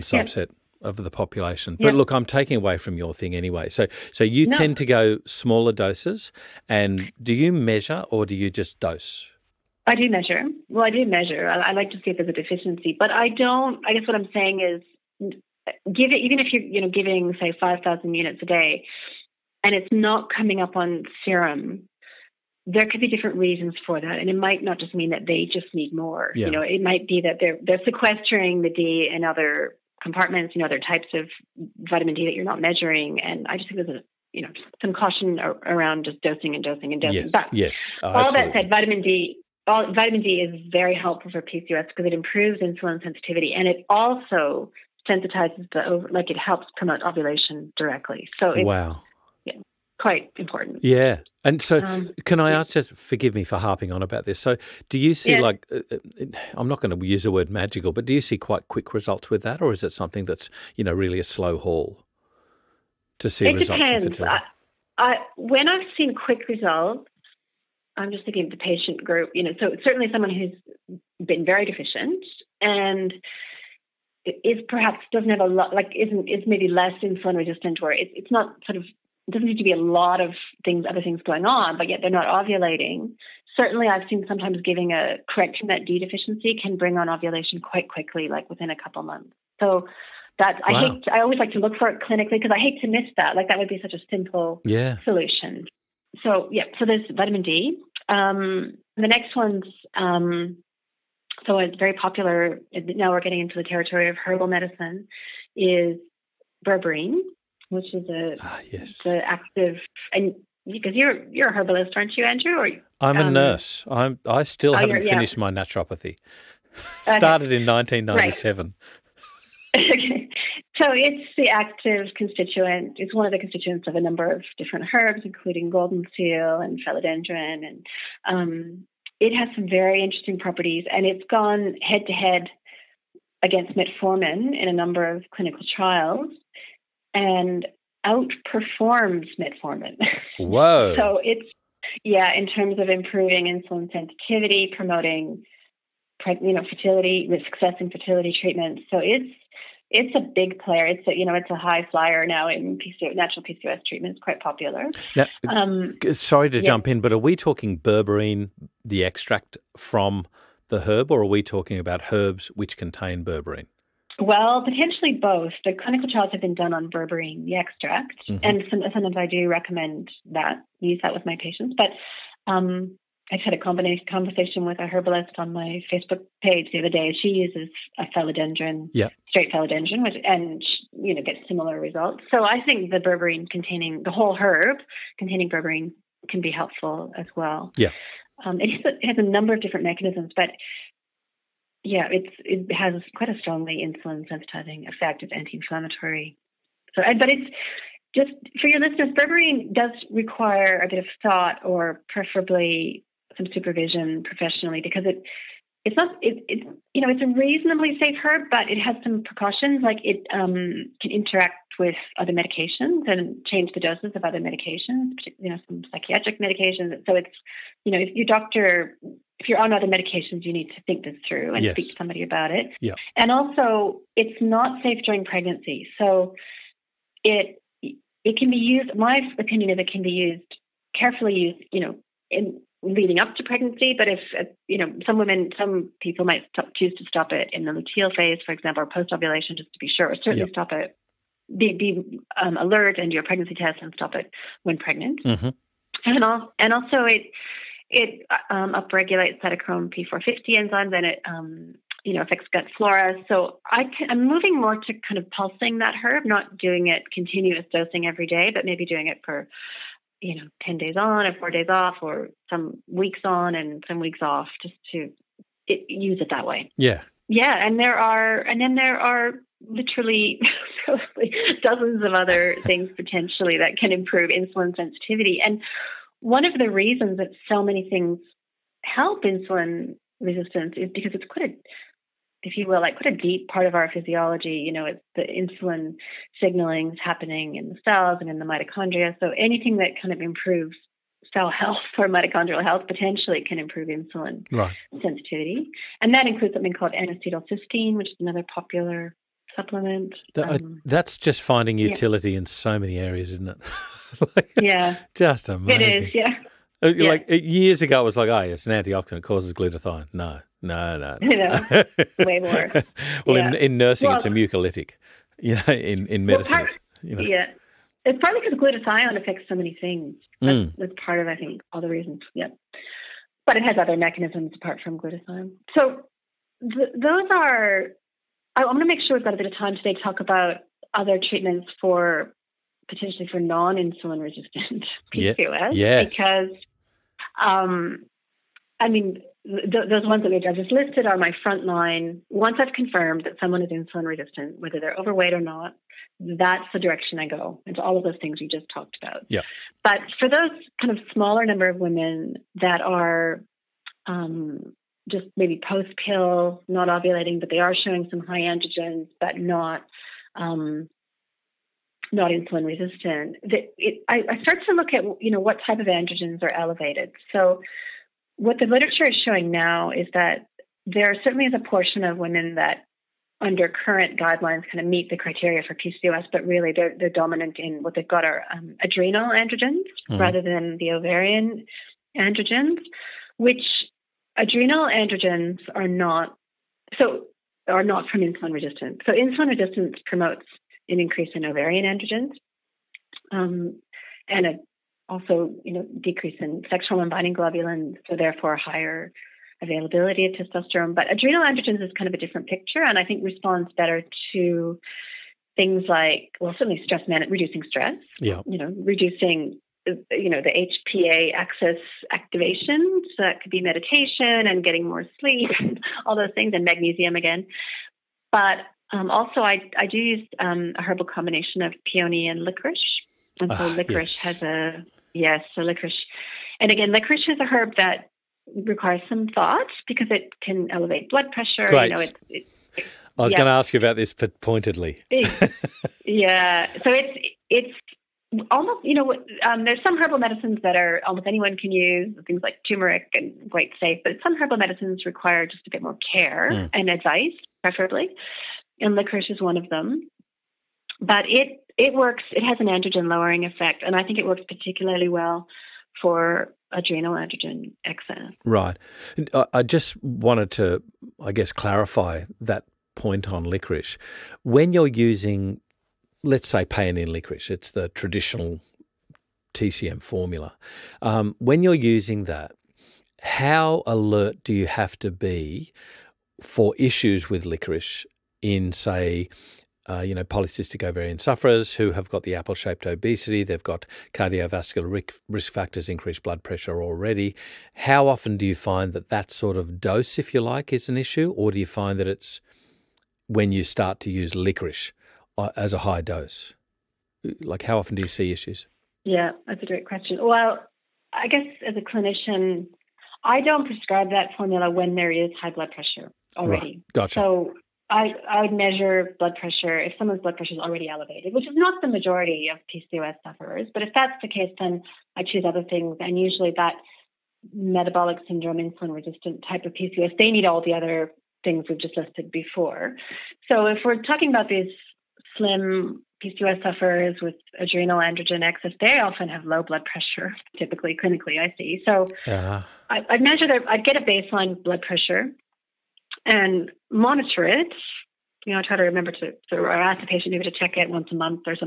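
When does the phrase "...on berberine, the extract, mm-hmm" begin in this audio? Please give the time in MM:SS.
02:46.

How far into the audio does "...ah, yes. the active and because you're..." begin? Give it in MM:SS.
01:48.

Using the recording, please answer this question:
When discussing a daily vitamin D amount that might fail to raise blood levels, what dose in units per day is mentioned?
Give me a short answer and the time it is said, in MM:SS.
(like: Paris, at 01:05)
5,000 units, at 00:17.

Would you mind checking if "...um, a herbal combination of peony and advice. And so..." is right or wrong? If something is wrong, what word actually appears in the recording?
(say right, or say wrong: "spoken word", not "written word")
wrong: "licorice", not "advice".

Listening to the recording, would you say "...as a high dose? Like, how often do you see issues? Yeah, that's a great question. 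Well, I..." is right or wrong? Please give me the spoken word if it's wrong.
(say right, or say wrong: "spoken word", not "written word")
right.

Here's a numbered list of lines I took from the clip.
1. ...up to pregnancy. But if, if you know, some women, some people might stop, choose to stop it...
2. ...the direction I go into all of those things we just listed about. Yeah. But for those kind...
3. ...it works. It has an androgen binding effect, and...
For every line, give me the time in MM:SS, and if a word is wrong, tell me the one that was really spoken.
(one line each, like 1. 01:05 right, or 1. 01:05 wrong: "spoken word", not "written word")
1. 03:53 right
2. 05:46 wrong: "talked", not "listed"
3. 07:31 wrong: "lowering", not "binding".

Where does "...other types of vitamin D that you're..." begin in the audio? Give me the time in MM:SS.
00:30.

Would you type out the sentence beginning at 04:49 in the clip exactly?
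So anything that kind of improves cell health or mitochondrial health potentially can improve insulin right.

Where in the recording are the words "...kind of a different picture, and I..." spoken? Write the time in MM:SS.
06:41.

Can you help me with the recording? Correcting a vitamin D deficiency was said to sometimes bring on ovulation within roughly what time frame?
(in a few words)
a couple months.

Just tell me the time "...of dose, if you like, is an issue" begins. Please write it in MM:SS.
08:09.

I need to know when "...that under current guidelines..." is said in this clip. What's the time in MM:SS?
06:12.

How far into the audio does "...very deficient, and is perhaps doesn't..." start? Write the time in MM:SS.
01:11.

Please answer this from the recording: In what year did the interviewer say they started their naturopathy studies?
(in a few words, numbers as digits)
1997.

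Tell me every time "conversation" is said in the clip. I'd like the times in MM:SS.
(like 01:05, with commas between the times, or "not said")
02:53.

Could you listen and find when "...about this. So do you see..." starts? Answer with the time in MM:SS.
00:54.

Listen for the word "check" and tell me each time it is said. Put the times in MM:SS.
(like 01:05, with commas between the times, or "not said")
09:00.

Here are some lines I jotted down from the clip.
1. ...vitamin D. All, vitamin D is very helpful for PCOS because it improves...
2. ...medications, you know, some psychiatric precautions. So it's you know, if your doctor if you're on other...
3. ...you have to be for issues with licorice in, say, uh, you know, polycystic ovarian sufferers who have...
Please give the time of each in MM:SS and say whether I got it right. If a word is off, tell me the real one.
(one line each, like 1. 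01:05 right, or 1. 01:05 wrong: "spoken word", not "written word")
1. 00:38 right
2. 03:34 wrong: "medications", not "precautions"
3. 07:54 right.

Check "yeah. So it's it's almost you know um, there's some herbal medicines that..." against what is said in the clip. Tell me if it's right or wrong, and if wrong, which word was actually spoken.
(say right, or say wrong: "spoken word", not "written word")
right.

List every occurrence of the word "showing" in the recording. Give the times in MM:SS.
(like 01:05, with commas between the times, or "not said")
05:57, 06:09.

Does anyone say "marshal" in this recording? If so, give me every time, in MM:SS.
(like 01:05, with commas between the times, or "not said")
not said.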